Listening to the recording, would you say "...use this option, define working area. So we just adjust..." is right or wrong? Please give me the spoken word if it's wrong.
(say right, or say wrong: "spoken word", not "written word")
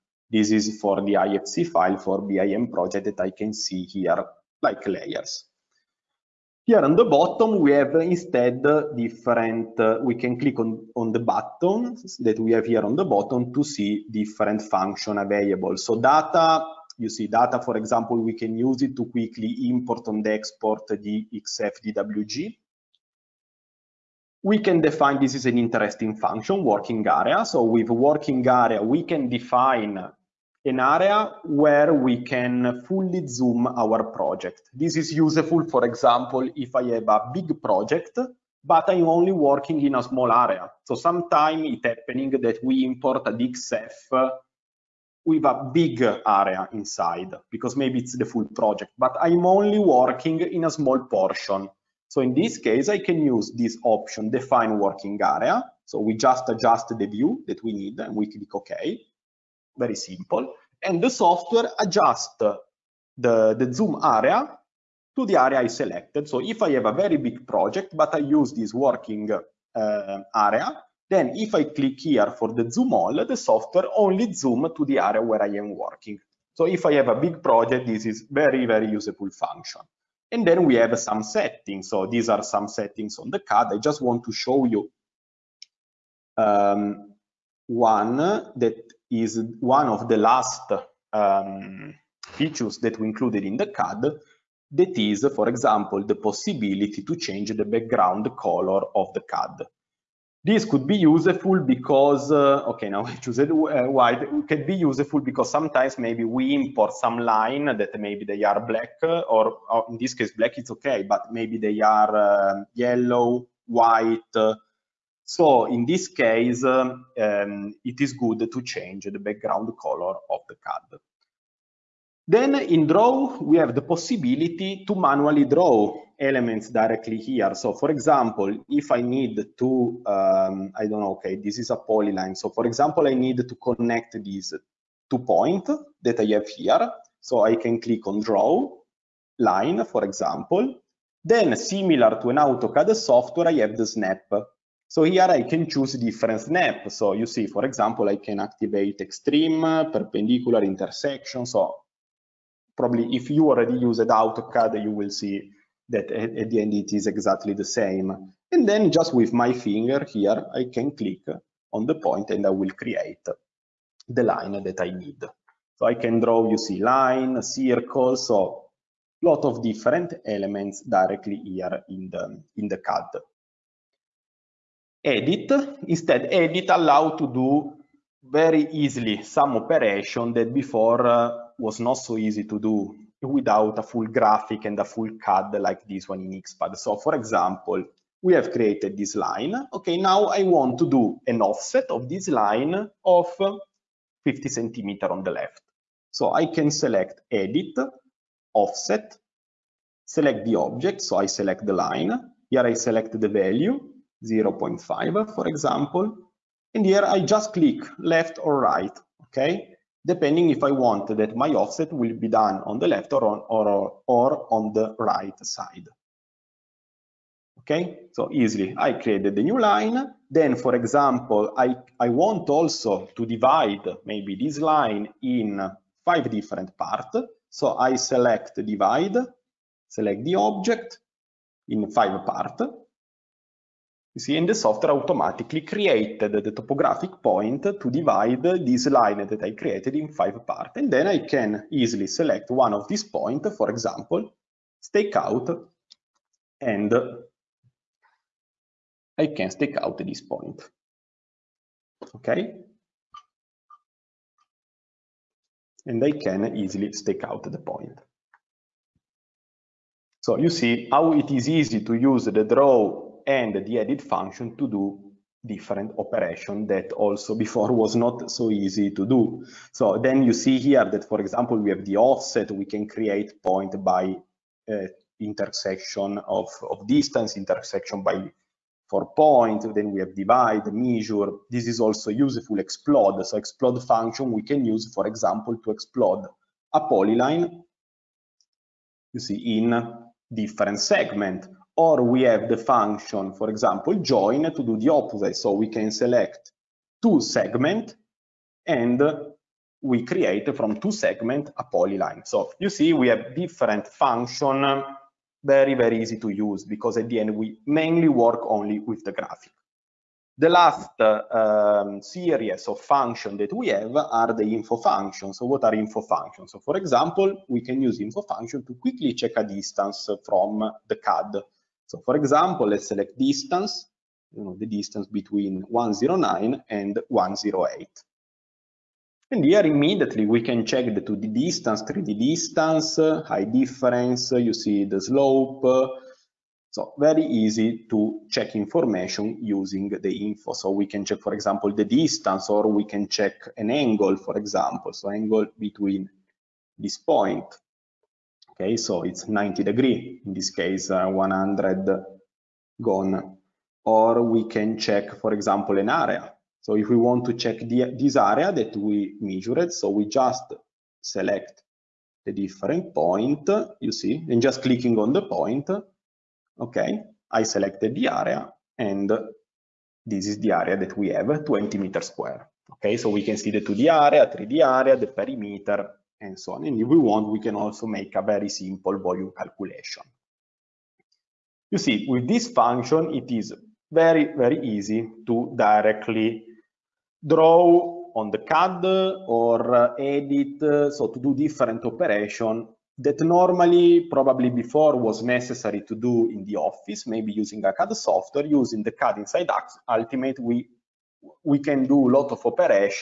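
right.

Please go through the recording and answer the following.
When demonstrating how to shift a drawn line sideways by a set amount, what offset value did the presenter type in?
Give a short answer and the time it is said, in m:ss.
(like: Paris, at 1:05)
0.5, at 3:24.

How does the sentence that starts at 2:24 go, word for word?
So here I can choose different snap.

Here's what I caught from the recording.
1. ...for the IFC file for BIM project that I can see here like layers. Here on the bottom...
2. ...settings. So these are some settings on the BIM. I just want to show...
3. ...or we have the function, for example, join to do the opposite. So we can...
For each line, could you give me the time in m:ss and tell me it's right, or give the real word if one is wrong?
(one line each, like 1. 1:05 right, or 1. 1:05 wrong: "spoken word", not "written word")
1. 0:00 right
2. 1:21 wrong: "CAD", not "BIM"
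3. 4:51 right.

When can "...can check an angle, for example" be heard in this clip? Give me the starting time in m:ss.
5:42.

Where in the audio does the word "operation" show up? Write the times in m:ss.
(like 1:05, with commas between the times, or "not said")
2:59, 4:25, 6:31, 6:42.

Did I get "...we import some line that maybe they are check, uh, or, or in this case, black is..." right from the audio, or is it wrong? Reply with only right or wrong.
wrong.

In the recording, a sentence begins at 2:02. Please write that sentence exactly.
Then in draw, we have the possibility to manually draw elements directly here.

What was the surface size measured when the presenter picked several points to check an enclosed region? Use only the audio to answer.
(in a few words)
20 square meters.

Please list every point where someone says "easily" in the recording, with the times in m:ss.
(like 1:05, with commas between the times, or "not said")
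2:58, 3:38, 4:01, 4:16.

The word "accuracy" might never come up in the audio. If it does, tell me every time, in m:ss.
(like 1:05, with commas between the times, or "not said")
not said.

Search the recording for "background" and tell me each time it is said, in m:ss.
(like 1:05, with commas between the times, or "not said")
1:37, 1:59.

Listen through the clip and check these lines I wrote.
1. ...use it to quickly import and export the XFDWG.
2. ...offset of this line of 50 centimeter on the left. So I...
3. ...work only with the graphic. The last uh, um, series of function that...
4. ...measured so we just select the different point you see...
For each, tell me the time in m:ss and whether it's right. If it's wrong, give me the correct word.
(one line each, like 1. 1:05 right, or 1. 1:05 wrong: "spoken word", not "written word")
1. 0:18 right
2. 3:11 right
3. 5:08 right
4. 5:59 right.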